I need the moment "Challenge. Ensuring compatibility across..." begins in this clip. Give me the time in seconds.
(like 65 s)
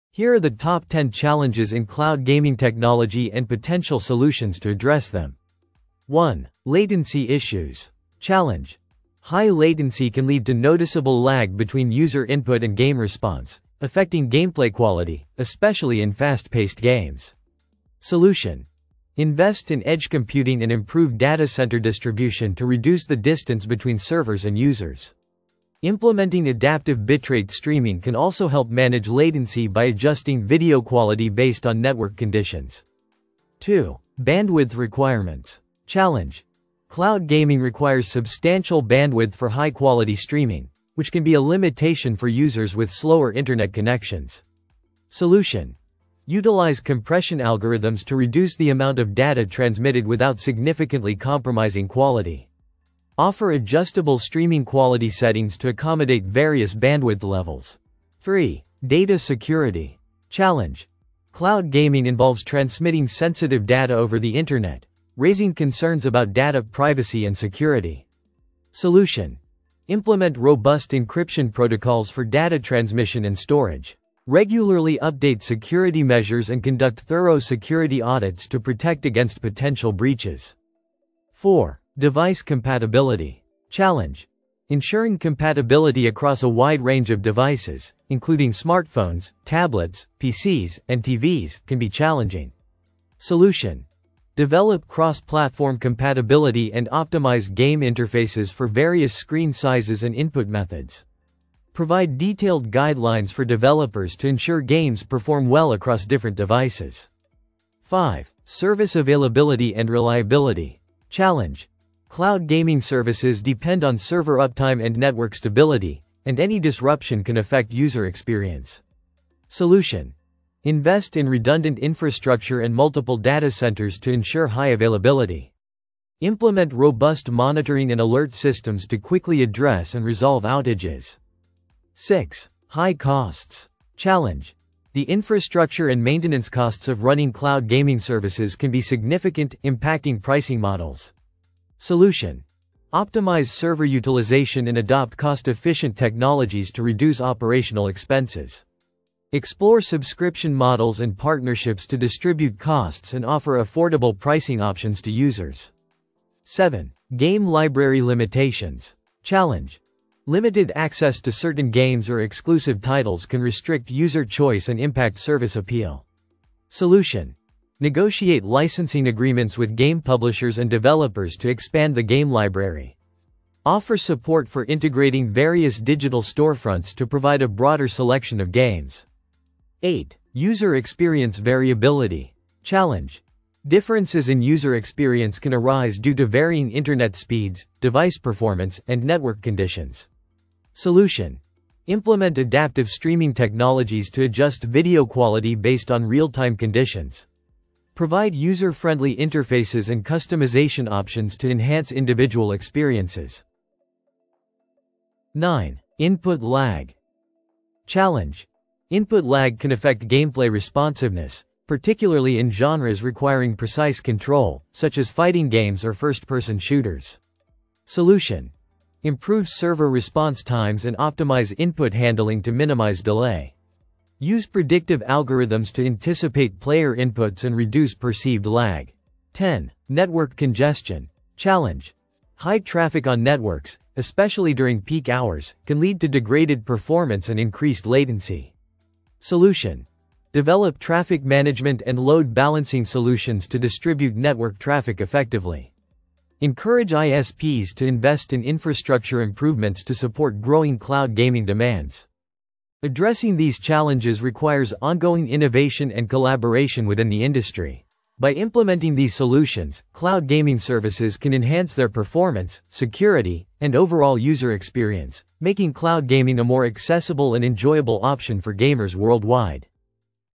83 s.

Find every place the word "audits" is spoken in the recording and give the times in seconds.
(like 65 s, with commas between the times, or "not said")
78 s.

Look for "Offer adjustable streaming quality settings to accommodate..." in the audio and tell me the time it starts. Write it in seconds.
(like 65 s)
53 s.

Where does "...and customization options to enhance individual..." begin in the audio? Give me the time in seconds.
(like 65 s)
199 s.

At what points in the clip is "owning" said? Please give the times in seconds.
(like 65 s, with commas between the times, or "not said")
not said.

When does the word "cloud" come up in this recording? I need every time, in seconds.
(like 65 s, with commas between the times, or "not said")
1 s, 36 s, 61 s, 112 s, 137 s, 250 s, 259 s, 265 s.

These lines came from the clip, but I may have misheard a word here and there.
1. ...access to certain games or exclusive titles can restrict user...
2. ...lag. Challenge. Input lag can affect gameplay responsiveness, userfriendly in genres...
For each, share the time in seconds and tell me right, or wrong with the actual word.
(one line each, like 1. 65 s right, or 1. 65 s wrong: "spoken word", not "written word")
1. 160 s right
2. 206 s wrong: "particularly", not "userfriendly".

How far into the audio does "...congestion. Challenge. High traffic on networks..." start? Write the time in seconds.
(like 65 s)
230 s.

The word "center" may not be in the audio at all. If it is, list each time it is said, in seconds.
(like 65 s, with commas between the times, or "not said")
21 s, 123 s.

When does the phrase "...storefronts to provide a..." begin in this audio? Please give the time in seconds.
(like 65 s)
176 s.